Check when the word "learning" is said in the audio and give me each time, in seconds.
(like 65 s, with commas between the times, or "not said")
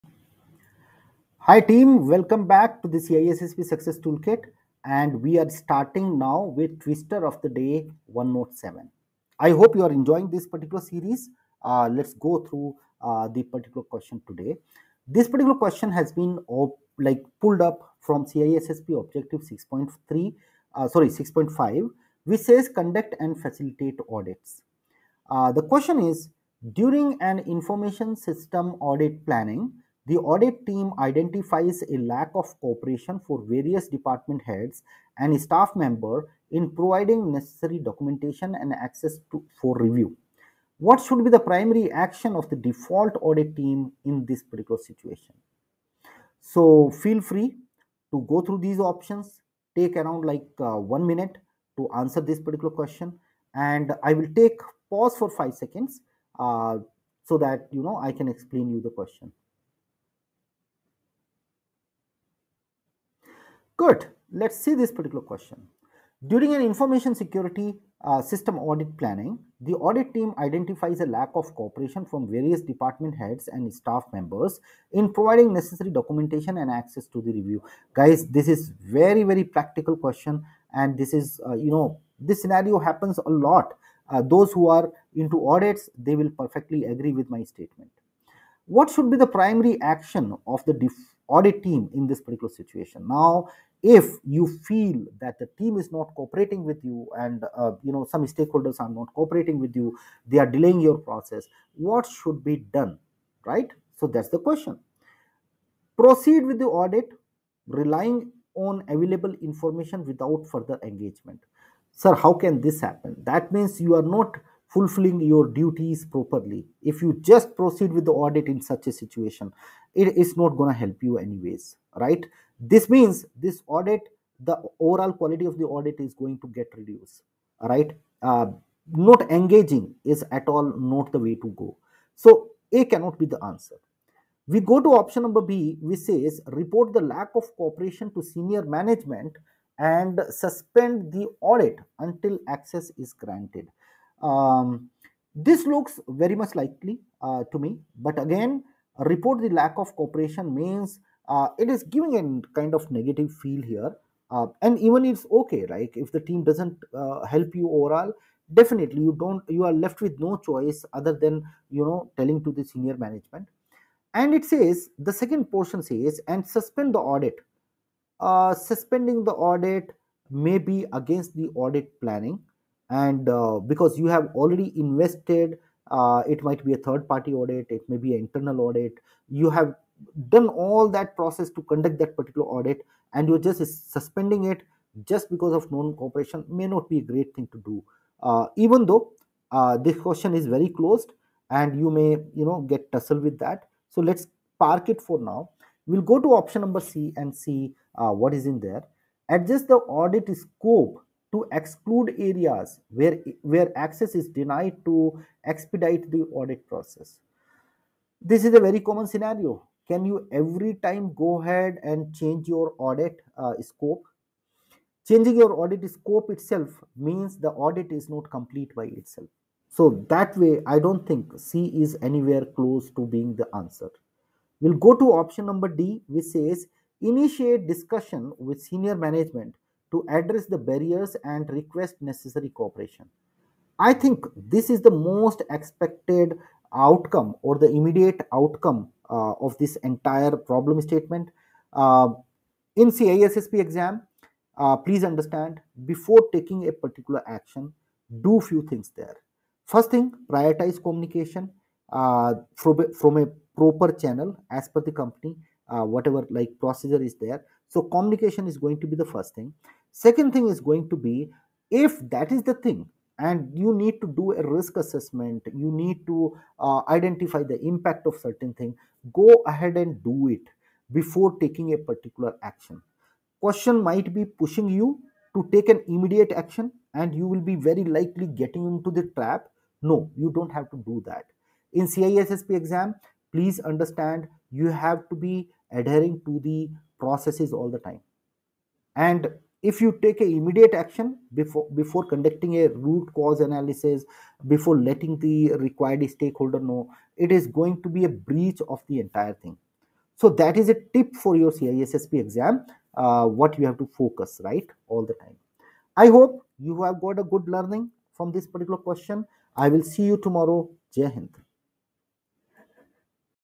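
307 s.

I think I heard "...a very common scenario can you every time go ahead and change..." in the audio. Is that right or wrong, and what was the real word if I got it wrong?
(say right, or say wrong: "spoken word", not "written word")
right.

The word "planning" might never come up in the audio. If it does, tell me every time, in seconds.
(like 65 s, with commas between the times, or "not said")
29 s, 68 s, 171 s.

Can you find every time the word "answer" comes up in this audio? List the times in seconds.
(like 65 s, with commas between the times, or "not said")
51 s, 133 s, 223 s.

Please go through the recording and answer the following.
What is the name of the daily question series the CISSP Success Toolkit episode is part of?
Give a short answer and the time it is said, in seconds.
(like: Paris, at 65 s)
Twister of the Day, at 6 s.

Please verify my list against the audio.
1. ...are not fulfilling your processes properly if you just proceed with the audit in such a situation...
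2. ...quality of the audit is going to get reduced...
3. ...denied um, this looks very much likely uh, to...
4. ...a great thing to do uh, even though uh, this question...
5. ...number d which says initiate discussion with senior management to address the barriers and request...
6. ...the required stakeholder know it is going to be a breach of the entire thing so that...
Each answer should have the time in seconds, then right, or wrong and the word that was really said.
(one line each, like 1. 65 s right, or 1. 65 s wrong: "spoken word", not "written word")
1. 113 s wrong: "duties", not "processes"
2. 125 s right
3. 143 s wrong: "granted", not "denied"
4. 186 s right
5. 225 s right
6. 295 s right.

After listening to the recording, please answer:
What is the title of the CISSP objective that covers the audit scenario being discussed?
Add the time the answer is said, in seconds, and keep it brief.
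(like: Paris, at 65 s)
Conduct and facilitate audits, at 22 s.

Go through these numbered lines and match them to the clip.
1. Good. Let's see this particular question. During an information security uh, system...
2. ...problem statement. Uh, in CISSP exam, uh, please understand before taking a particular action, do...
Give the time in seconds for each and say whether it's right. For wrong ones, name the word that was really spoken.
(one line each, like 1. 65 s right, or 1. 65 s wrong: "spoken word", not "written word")
1. 63 s right
2. 240 s right.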